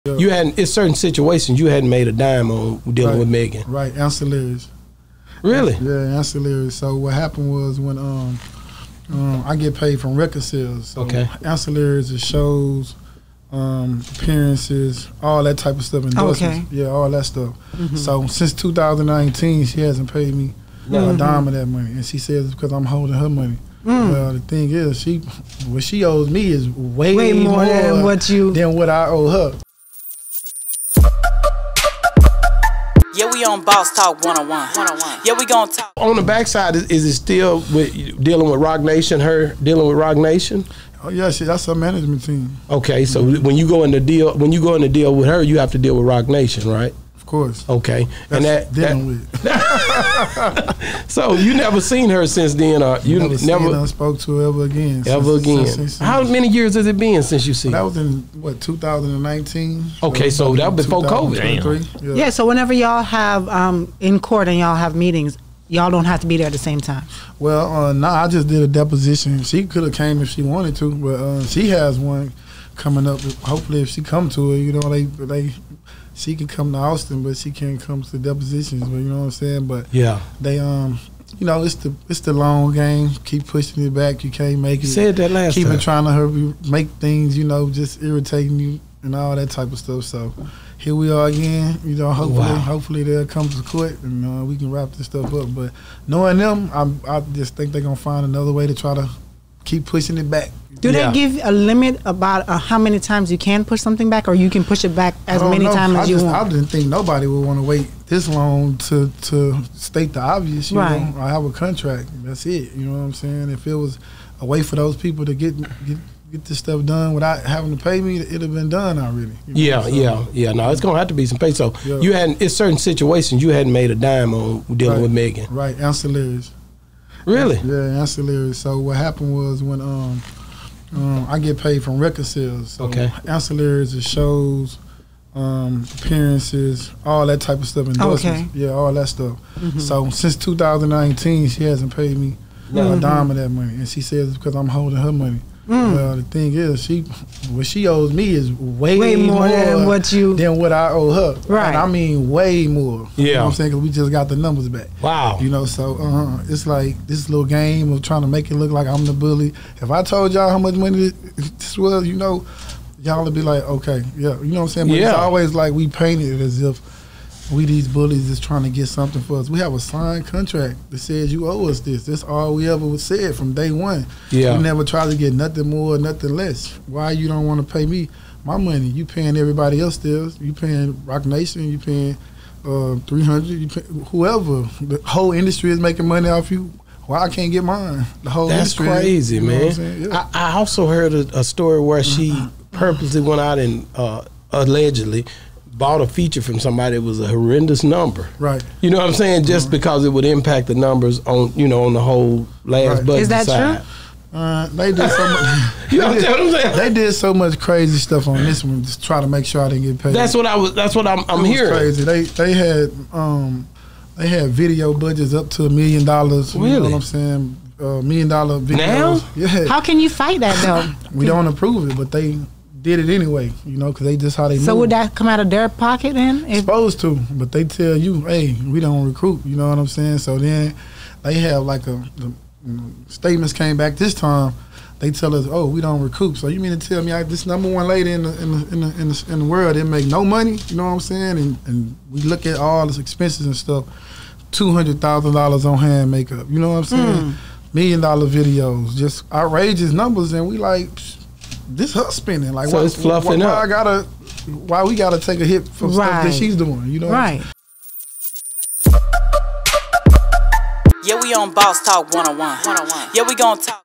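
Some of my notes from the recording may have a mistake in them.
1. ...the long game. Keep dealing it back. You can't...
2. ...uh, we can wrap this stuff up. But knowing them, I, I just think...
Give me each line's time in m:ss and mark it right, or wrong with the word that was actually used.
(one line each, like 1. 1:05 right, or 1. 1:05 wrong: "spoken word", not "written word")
1. 1:22 wrong: "pushing", not "dealing"
2. 1:34 right.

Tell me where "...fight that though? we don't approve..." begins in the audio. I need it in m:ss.
3:40.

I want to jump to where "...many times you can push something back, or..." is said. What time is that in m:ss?
1:42.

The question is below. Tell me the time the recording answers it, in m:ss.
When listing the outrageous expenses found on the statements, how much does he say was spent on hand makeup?
4:04.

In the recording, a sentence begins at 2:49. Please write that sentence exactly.
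We have a signed contract that says you owe us this.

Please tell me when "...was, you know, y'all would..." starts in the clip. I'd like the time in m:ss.
2:41.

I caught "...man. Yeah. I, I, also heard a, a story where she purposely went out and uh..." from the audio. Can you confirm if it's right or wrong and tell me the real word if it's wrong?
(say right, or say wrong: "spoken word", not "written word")
right.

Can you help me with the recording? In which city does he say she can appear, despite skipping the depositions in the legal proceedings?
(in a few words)
Austin.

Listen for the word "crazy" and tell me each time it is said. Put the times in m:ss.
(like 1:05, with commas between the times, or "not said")
3:08, 3:27, 3:31.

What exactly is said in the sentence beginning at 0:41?
Oh yeah, she, that's her management team.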